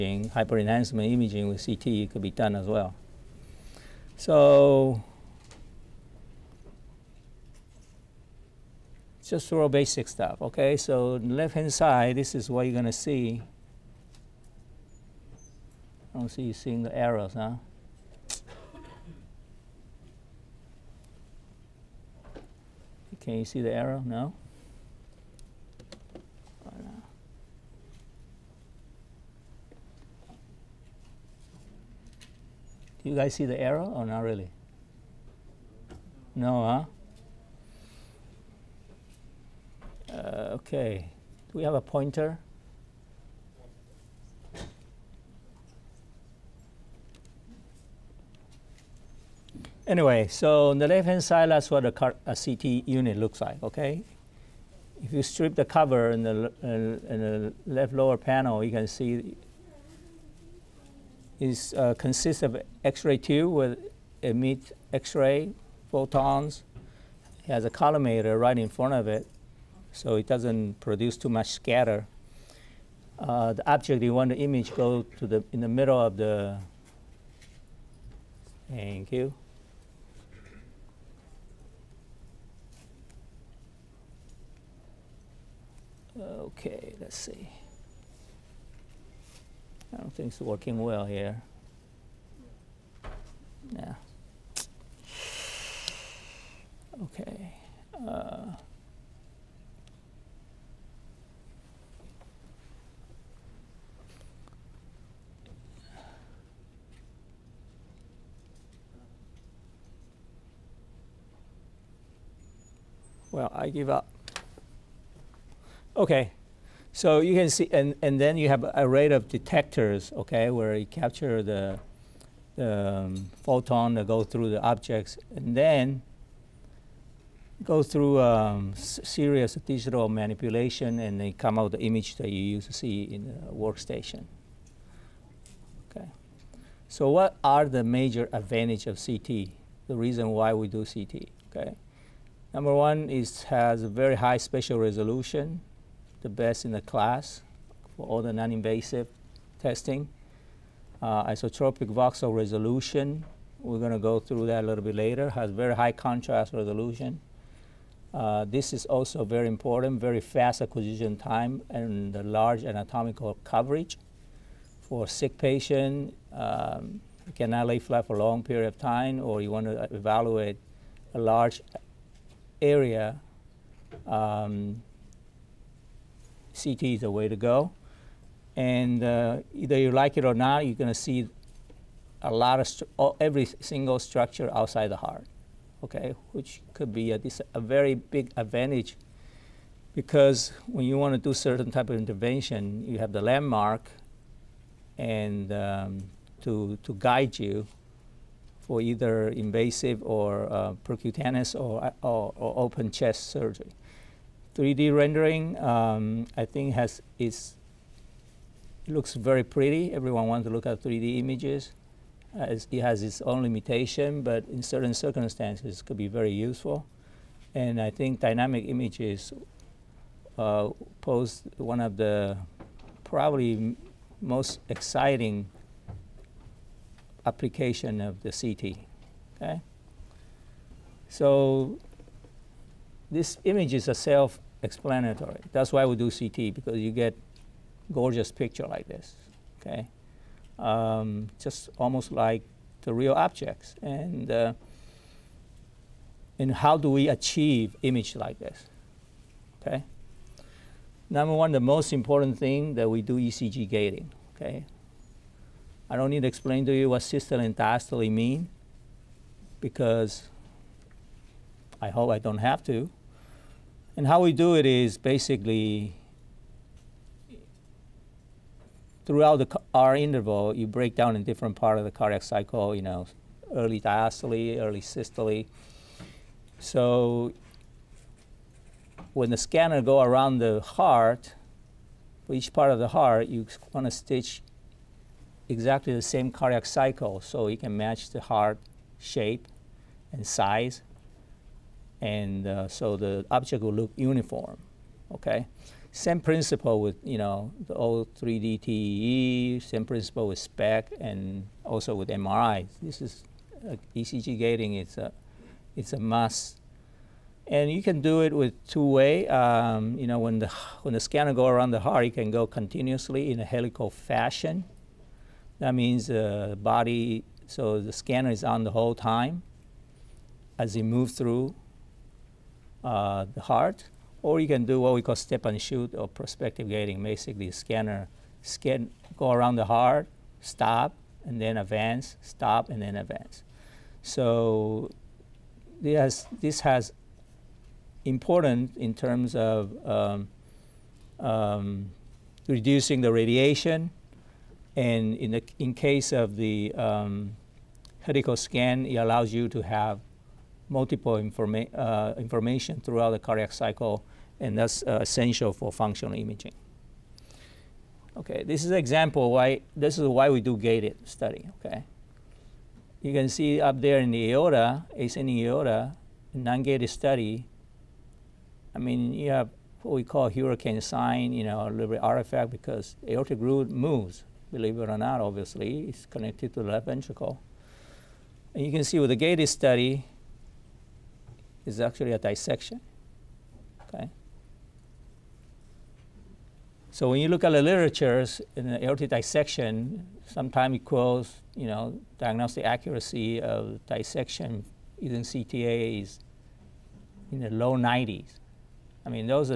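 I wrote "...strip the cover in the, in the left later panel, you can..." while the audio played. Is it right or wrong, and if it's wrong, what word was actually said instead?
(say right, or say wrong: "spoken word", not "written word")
wrong: "lower", not "later".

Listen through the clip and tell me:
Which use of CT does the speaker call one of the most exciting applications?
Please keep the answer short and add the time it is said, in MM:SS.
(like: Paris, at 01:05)
Dynamic images, at 03:38.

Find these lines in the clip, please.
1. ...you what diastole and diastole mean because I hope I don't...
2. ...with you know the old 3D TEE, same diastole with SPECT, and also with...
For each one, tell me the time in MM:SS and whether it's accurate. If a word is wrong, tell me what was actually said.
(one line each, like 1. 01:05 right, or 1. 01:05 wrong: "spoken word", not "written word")
1. 04:16 wrong: "systole", not "diastole"
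2. 04:56 wrong: "principle", not "diastole".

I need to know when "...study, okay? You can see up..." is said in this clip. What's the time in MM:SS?
06:01.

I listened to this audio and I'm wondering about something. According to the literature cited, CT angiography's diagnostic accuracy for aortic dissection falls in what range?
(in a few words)
Low 90s.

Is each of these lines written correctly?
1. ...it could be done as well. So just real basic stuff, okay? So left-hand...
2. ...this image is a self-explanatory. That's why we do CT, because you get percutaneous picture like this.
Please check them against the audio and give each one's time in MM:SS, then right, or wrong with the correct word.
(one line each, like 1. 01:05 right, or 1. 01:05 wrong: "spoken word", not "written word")
1. 00:01 right
2. 03:53 wrong: "gorgeous", not "percutaneous".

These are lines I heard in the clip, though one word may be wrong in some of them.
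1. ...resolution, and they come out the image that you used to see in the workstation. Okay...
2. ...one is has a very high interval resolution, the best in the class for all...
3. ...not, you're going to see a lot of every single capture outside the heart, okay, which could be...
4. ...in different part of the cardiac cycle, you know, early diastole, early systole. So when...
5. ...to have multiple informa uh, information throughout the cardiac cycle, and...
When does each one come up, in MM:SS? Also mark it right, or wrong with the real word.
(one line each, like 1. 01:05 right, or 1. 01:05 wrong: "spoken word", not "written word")
1. 02:10 wrong: "manipulation", not "resolution"
2. 02:22 wrong: "spatial", not "interval"
3. 03:00 wrong: "structure", not "capture"
4. 04:31 right
5. 05:49 right.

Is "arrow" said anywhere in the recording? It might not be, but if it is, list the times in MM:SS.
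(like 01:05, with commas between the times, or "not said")
00:16, 00:23, 00:33.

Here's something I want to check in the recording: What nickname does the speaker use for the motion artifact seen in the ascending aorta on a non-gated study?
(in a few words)
Hurricane sign.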